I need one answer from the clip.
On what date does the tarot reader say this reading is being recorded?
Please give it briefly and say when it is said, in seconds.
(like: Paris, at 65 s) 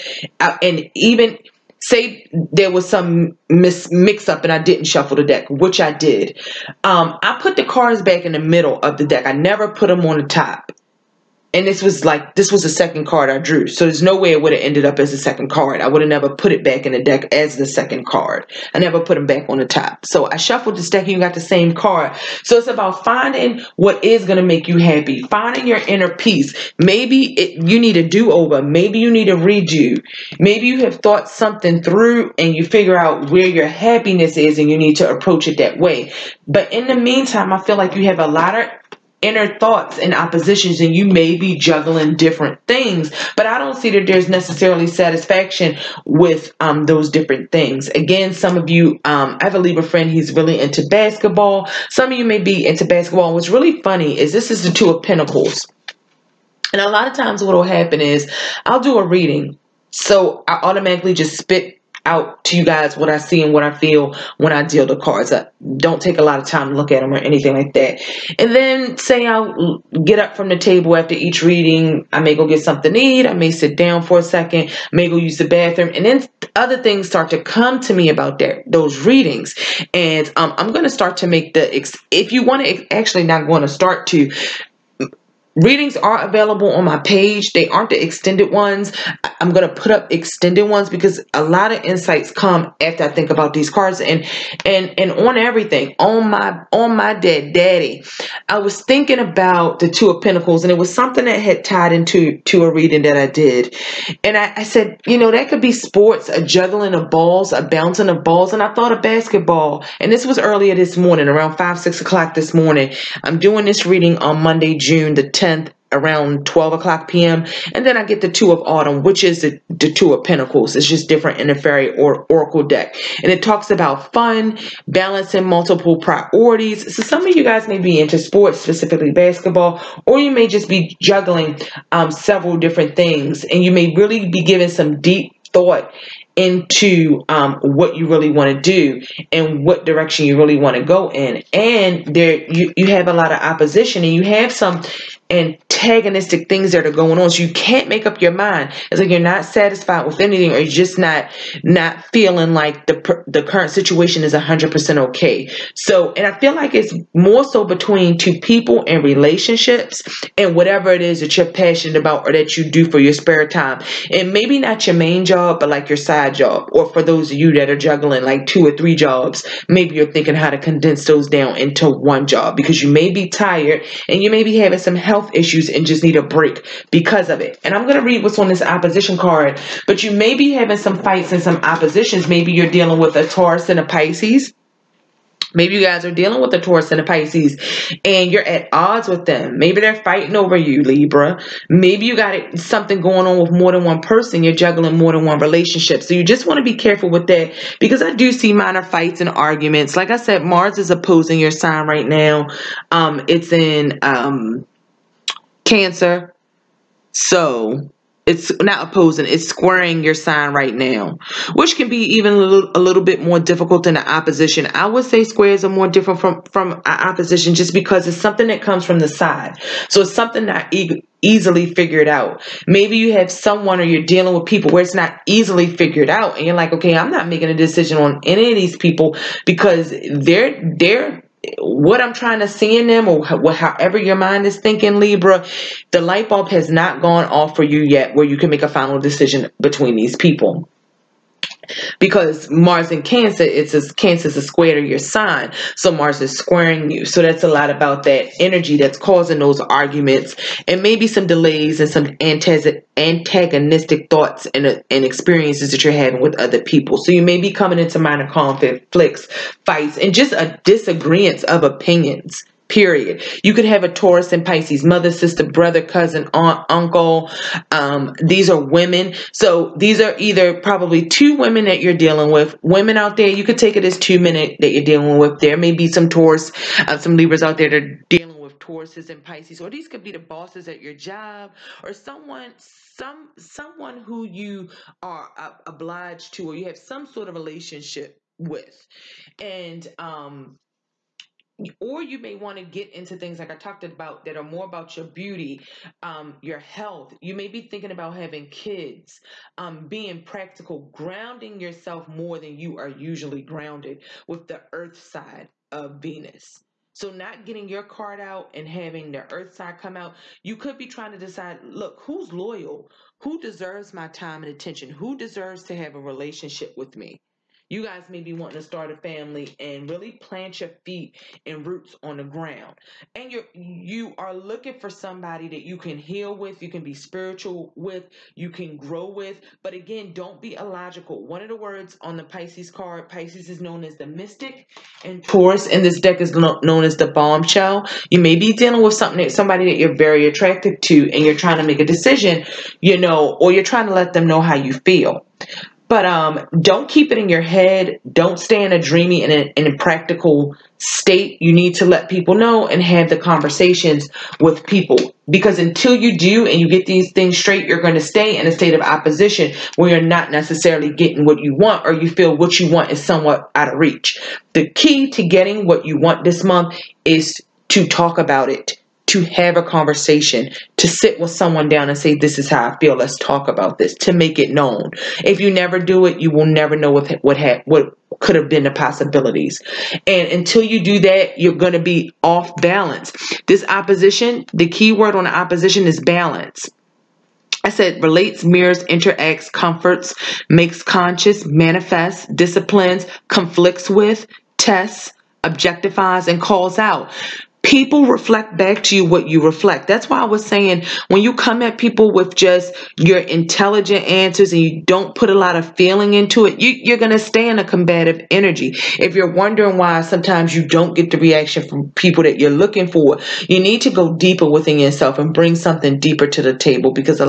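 Monday, June 10th, at 114 s.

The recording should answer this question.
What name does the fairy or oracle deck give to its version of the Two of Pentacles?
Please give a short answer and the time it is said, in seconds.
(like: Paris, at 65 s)
Two of Autumn, at 118 s.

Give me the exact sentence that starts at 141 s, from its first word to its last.
And there you, you have a lot of opposition and you have some antagonistic things that are going on.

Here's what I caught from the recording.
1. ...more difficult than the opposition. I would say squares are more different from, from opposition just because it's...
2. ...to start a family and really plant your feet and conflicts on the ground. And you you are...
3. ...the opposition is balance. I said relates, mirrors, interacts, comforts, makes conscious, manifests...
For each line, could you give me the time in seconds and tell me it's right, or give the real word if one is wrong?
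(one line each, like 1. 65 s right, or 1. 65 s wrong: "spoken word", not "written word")
1. 213 s right
2. 318 s wrong: "roots", not "conflicts"
3. 385 s right.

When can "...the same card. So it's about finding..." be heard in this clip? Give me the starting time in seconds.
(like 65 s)
21 s.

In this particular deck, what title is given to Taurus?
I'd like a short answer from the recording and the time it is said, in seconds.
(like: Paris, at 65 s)
The bombshell, at 336 s.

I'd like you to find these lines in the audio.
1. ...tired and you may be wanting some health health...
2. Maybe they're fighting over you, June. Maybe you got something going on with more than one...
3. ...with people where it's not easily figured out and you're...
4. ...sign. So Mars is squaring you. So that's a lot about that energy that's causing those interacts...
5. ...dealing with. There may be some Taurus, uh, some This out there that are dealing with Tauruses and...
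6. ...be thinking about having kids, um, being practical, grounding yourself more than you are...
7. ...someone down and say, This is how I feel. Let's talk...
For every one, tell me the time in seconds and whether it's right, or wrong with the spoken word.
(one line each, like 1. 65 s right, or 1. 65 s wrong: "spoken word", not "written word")
1. 173 s wrong: "having", not "wanting"
2. 189 s wrong: "Libra", not "June"
3. 224 s right
4. 244 s wrong: "arguments", not "interacts"
5. 274 s wrong: "Libras", not "This"
6. 297 s right
7. 371 s right.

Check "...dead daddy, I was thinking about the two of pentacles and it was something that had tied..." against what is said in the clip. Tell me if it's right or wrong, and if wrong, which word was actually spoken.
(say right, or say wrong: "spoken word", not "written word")
right.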